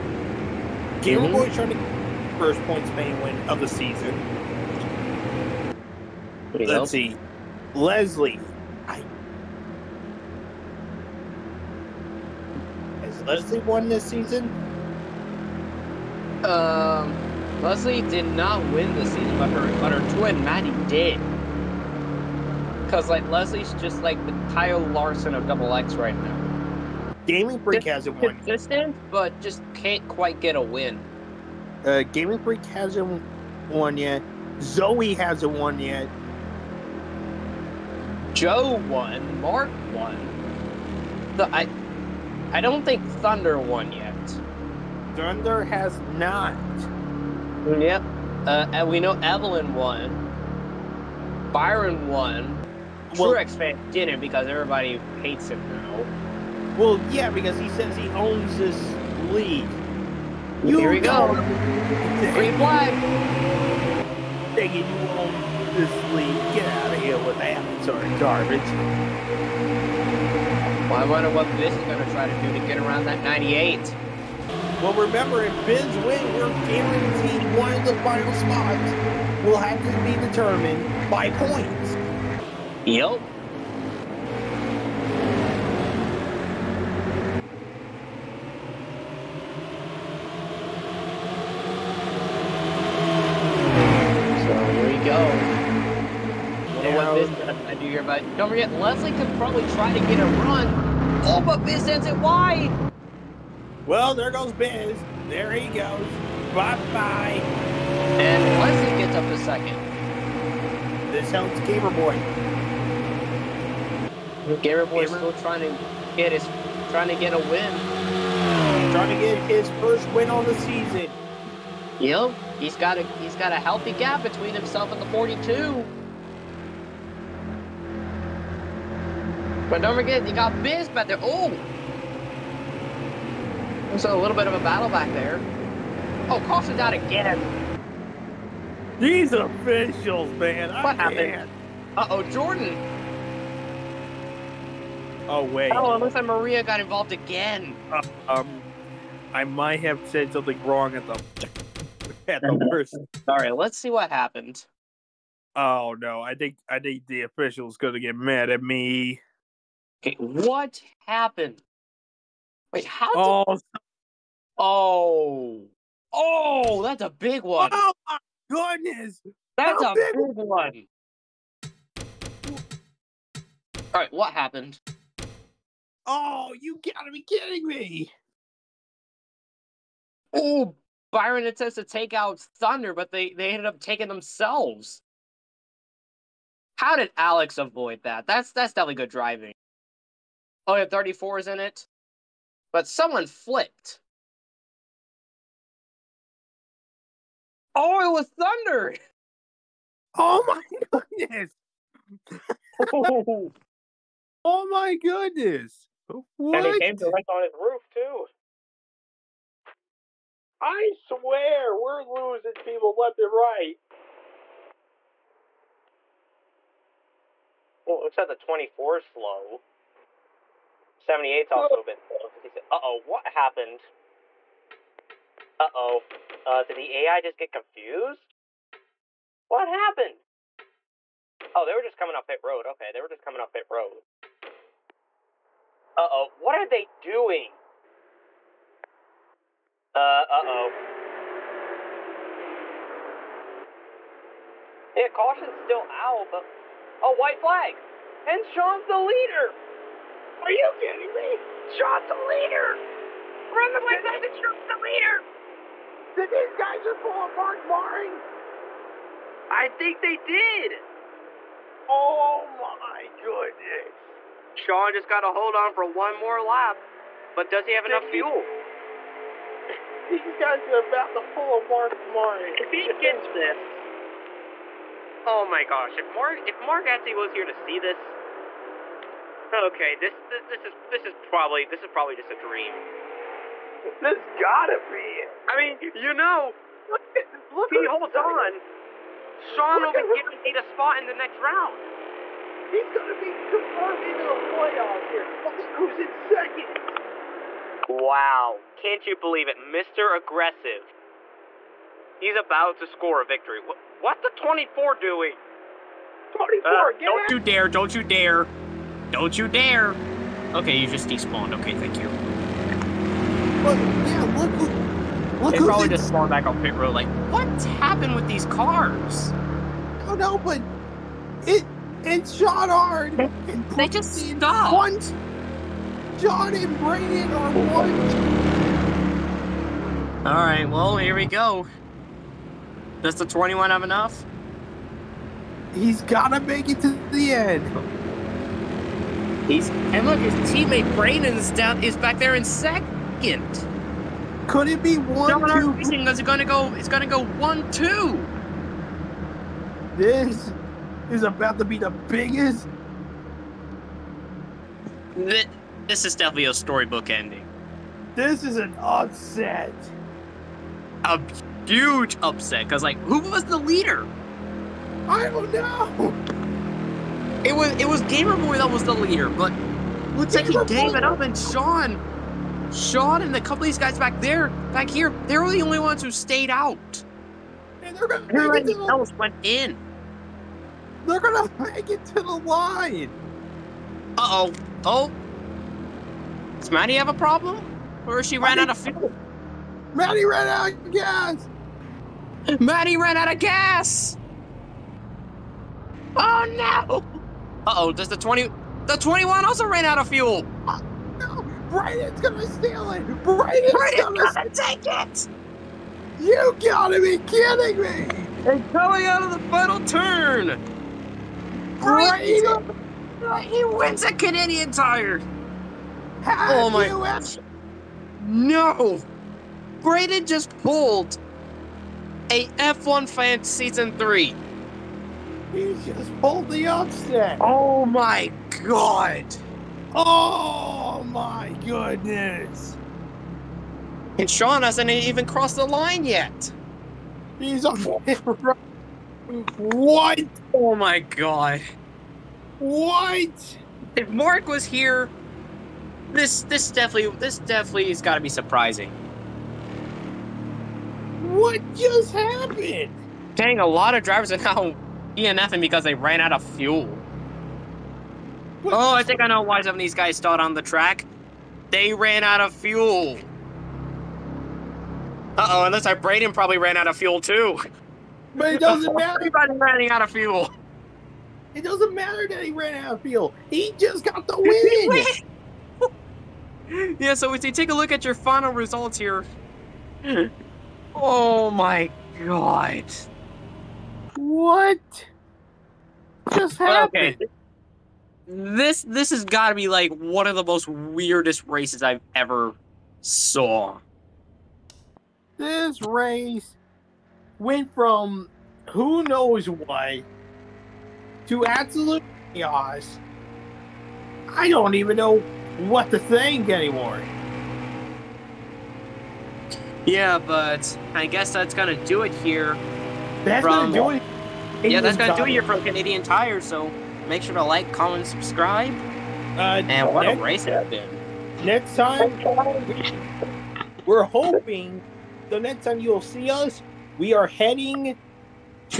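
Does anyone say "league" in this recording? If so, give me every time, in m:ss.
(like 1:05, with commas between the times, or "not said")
0:59, 1:06.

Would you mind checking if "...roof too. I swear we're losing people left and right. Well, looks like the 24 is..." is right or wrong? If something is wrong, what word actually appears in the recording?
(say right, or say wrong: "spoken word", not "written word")
right.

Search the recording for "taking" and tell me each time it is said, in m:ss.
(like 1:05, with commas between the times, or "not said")
3:03.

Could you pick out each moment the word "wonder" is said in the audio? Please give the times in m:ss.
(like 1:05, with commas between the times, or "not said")
1:11.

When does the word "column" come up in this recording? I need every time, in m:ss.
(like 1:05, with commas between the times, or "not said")
not said.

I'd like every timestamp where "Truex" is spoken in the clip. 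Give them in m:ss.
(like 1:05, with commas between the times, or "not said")
0:53.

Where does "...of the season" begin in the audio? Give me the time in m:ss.
0:03.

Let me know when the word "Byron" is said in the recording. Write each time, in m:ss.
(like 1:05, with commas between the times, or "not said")
0:51, 3:01.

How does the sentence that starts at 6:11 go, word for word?
And Sean, Sean, and a couple of these guys back there, back here, they were the only ones who stayed out.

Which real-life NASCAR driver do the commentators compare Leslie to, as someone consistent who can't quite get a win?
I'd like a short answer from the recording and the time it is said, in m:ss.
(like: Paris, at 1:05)
Kyle Larson, at 0:24.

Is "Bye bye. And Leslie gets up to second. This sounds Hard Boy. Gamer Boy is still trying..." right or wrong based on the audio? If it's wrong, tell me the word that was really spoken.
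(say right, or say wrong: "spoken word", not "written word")
wrong: "Gamer", not "Hard".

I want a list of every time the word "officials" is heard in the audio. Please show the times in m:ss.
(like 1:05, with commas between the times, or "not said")
2:19, 2:37.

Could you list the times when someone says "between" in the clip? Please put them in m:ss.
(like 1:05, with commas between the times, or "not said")
2:04.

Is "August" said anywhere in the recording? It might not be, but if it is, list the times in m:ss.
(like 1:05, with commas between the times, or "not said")
not said.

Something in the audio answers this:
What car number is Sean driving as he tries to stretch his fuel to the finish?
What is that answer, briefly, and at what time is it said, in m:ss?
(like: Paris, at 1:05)
21, at 5:33.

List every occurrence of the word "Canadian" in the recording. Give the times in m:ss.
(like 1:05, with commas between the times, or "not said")
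6:54, 8:35.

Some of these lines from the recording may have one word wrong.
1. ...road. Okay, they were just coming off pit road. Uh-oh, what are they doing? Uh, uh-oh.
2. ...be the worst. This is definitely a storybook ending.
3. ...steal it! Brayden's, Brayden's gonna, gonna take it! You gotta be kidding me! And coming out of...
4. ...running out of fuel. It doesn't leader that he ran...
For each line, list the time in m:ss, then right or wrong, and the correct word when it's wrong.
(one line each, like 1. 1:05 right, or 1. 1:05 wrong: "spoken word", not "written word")
1. 3:52 right
2. 5:51 wrong: "biggest", not "worst"
3. 6:42 right
4. 7:49 wrong: "matter", not "leader".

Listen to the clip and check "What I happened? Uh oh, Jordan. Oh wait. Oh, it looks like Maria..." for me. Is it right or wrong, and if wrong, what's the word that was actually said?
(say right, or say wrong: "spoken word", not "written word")
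right.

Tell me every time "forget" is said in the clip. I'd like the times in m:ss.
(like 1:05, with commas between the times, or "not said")
1:38, 2:09.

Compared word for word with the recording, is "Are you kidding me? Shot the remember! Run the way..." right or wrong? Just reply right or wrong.
wrong.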